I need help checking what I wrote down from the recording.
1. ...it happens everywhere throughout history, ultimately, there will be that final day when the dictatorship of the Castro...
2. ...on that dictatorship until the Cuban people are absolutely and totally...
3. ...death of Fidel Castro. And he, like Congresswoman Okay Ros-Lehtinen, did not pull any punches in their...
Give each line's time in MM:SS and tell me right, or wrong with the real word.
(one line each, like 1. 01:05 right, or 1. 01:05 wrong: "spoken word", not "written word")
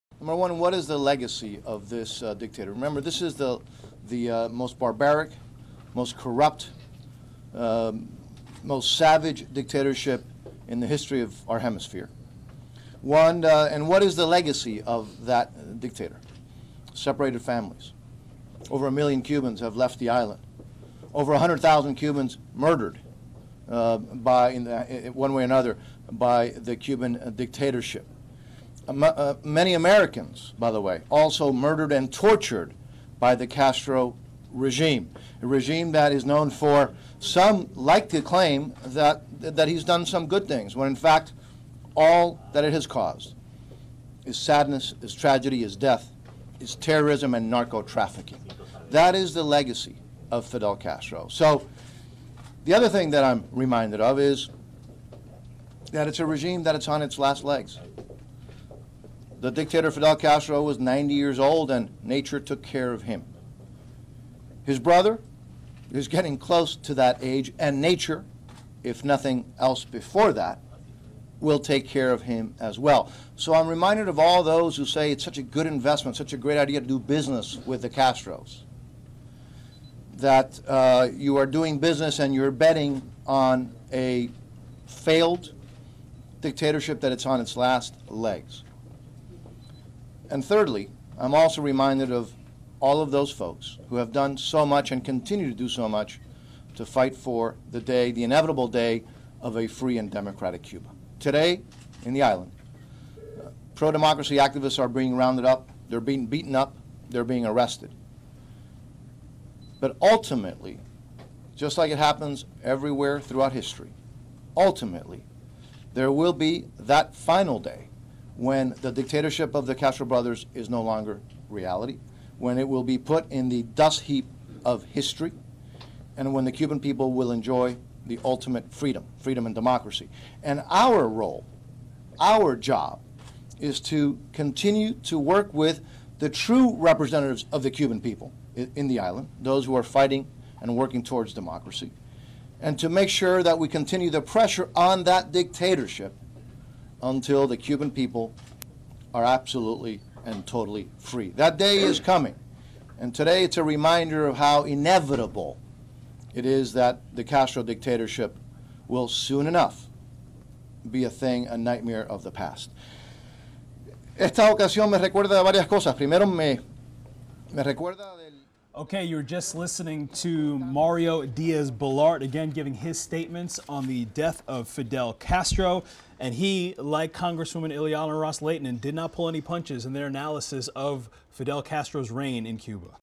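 1. 01:51 right
2. 02:24 right
3. 02:54 wrong: "Ileana", not "Okay".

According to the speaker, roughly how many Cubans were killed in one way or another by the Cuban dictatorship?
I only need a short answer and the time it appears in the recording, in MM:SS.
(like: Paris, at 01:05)
100,000, at 00:21.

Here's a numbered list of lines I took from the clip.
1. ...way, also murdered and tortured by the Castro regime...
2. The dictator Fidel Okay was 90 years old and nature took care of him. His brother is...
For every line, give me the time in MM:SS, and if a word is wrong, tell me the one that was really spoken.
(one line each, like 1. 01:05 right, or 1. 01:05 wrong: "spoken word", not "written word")
1. 00:30 right
2. 00:59 wrong: "Castro", not "Okay".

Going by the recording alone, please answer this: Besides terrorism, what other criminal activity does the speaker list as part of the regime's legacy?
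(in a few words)
narco trafficking.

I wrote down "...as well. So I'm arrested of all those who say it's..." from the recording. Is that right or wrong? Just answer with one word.
wrong.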